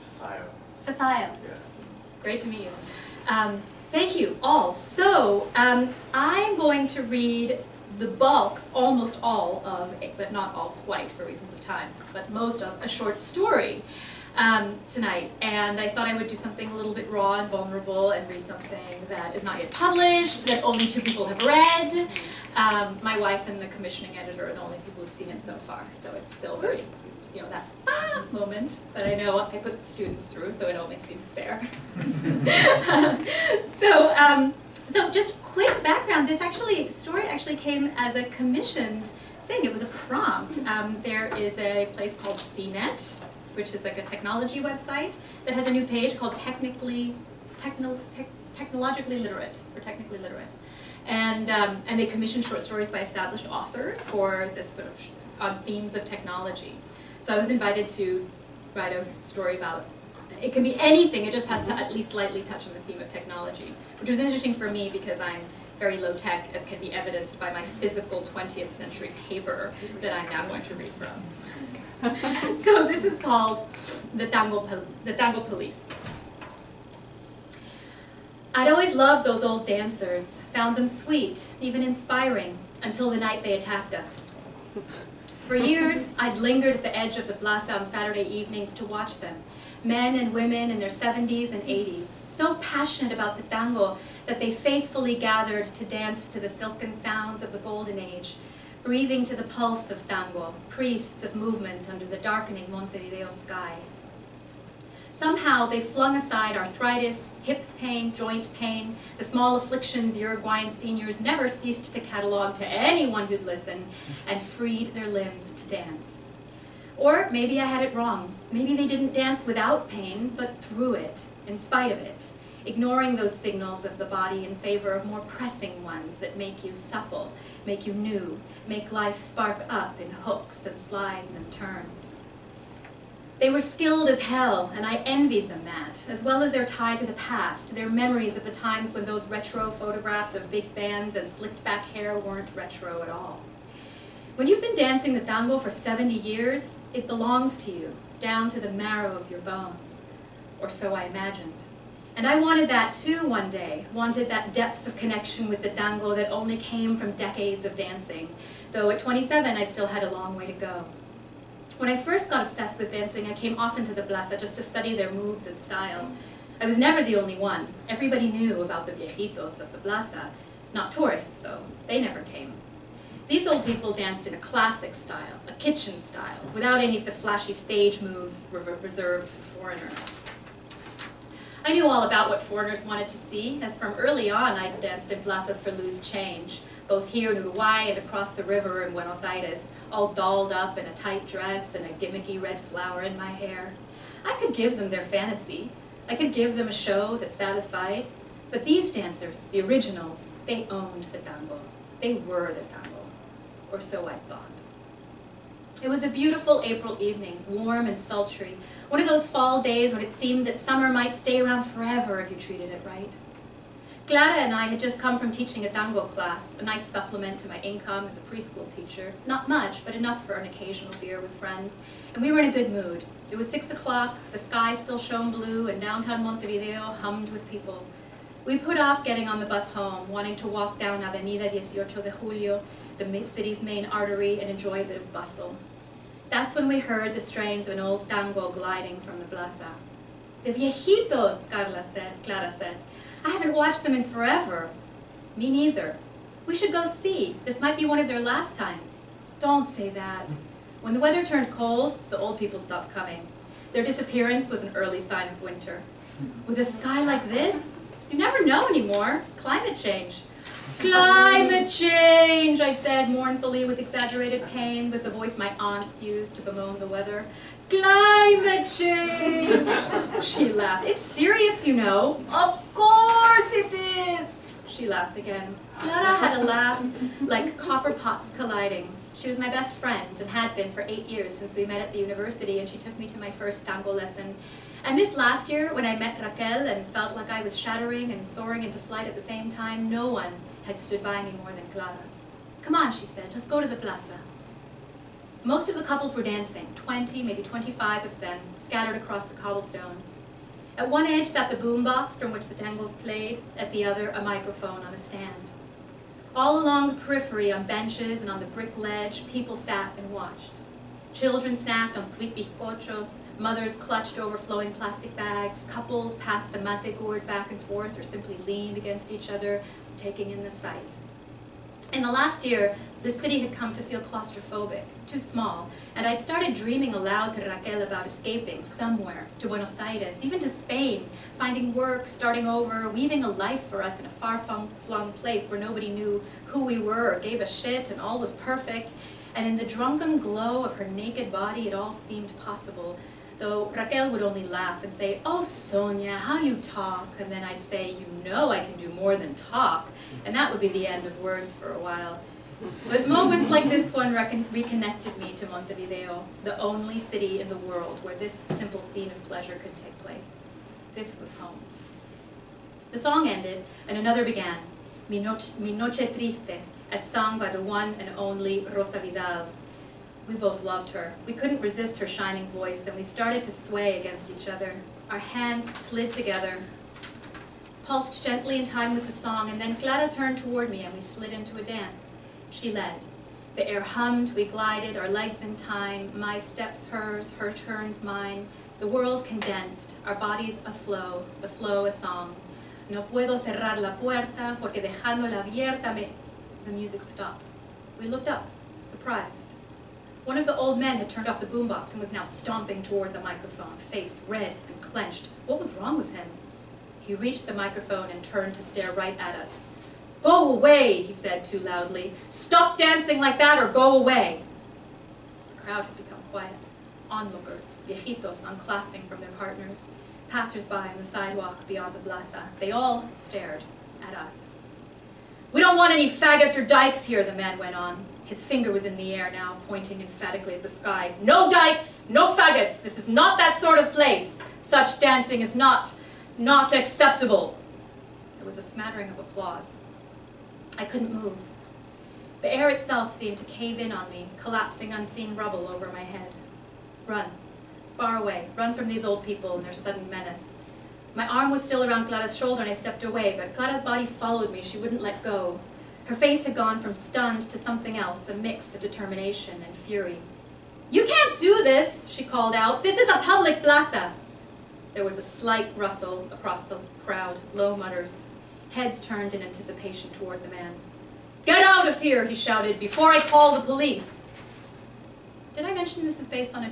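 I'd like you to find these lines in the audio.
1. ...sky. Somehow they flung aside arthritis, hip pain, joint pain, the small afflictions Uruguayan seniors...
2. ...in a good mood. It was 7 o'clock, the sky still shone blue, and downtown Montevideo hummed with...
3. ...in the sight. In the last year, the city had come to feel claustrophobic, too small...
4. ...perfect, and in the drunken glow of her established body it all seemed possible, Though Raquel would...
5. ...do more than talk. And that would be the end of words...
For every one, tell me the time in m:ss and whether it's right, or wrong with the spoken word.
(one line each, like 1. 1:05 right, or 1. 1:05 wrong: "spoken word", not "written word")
1. 1:43 right
2. 3:42 wrong: "6", not "7"
3. 5:20 right
4. 5:38 wrong: "naked", not "established"
5. 5:48 right.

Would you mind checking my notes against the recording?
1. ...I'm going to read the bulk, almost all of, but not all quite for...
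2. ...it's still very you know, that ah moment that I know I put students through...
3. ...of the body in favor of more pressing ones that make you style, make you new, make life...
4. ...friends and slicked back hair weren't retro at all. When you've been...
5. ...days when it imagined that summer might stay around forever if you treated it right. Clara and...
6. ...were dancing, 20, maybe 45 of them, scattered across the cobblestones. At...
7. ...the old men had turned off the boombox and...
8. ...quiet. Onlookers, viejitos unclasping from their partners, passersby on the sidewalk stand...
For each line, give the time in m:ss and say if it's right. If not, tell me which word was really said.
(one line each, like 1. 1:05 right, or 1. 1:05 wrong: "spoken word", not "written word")
1. 0:06 right
2. 0:26 right
3. 2:03 wrong: "supple", not "style"
4. 2:20 wrong: "bands", not "friends"
5. 3:29 wrong: "seemed", not "imagined"
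6. 4:56 wrong: "25", not "45"
7. 6:40 right
8. 6:56 wrong: "beyond", not "stand".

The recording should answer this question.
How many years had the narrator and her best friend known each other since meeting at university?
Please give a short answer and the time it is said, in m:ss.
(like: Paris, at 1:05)
8, at 4:40.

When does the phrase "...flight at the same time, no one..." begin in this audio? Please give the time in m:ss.
4:48.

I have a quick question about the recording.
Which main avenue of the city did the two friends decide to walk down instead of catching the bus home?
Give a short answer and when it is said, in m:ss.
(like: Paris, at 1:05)
Avenida 18 de Julio, at 3:51.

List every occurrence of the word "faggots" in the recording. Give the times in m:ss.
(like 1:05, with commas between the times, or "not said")
7:06, 7:12.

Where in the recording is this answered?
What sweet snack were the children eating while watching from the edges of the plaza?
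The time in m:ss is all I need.
5:12.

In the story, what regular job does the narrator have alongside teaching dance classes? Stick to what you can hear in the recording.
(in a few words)
Preschool teacher.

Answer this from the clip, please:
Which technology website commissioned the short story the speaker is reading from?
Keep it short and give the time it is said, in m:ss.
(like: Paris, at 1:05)
CNET, at 0:42.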